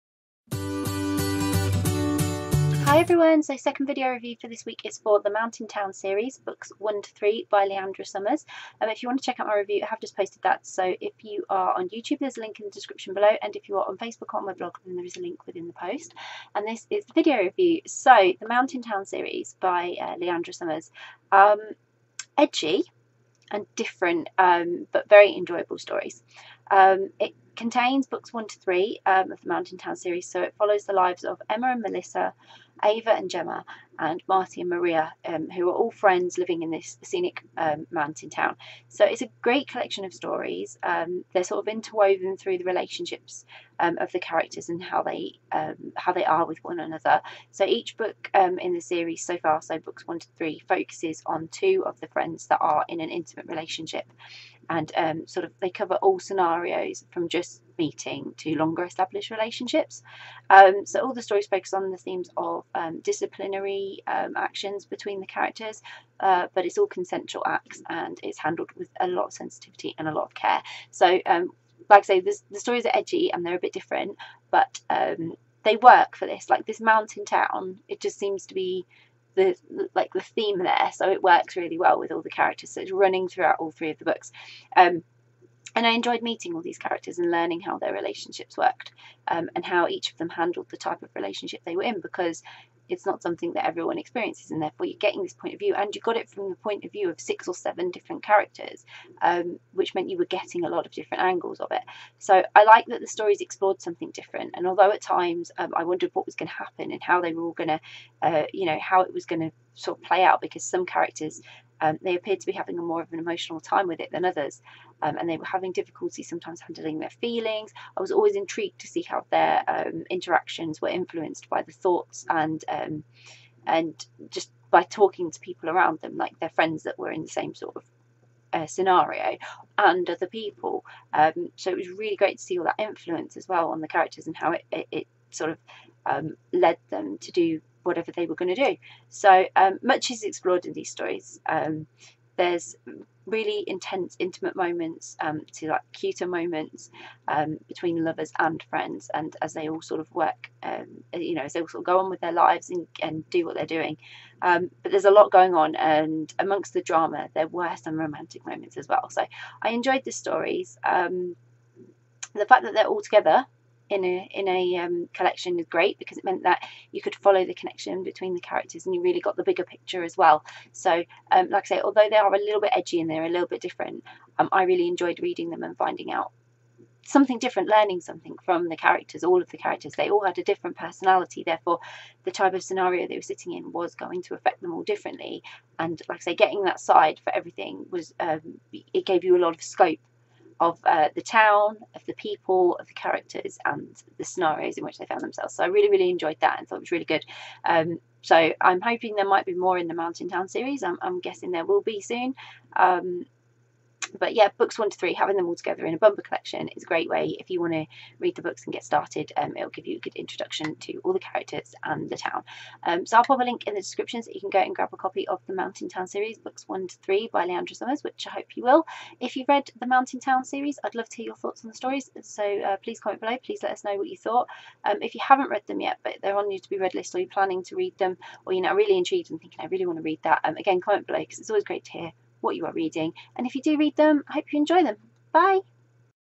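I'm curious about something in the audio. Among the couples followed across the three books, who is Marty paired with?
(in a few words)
Maria.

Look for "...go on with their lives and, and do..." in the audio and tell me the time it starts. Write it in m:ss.
2:31.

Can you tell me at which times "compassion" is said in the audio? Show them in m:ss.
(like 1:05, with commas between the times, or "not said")
not said.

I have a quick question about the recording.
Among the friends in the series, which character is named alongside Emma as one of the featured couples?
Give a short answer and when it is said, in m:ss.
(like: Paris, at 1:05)
Melissa, at 0:31.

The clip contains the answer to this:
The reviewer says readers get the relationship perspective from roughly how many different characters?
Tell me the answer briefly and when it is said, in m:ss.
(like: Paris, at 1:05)
6 or 7, at 1:37.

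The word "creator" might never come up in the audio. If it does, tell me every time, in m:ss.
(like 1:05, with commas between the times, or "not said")
not said.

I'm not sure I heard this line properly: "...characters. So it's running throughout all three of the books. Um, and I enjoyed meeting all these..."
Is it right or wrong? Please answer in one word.
right.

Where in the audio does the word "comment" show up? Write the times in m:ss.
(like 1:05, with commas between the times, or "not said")
3:42, 3:50.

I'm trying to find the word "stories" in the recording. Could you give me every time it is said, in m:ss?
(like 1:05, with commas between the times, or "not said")
0:25, 0:40, 1:01, 1:12, 1:43, 2:20, 2:40, 3:41.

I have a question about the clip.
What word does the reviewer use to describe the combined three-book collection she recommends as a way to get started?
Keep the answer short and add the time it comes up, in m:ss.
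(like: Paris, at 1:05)
bumper, at 3:25.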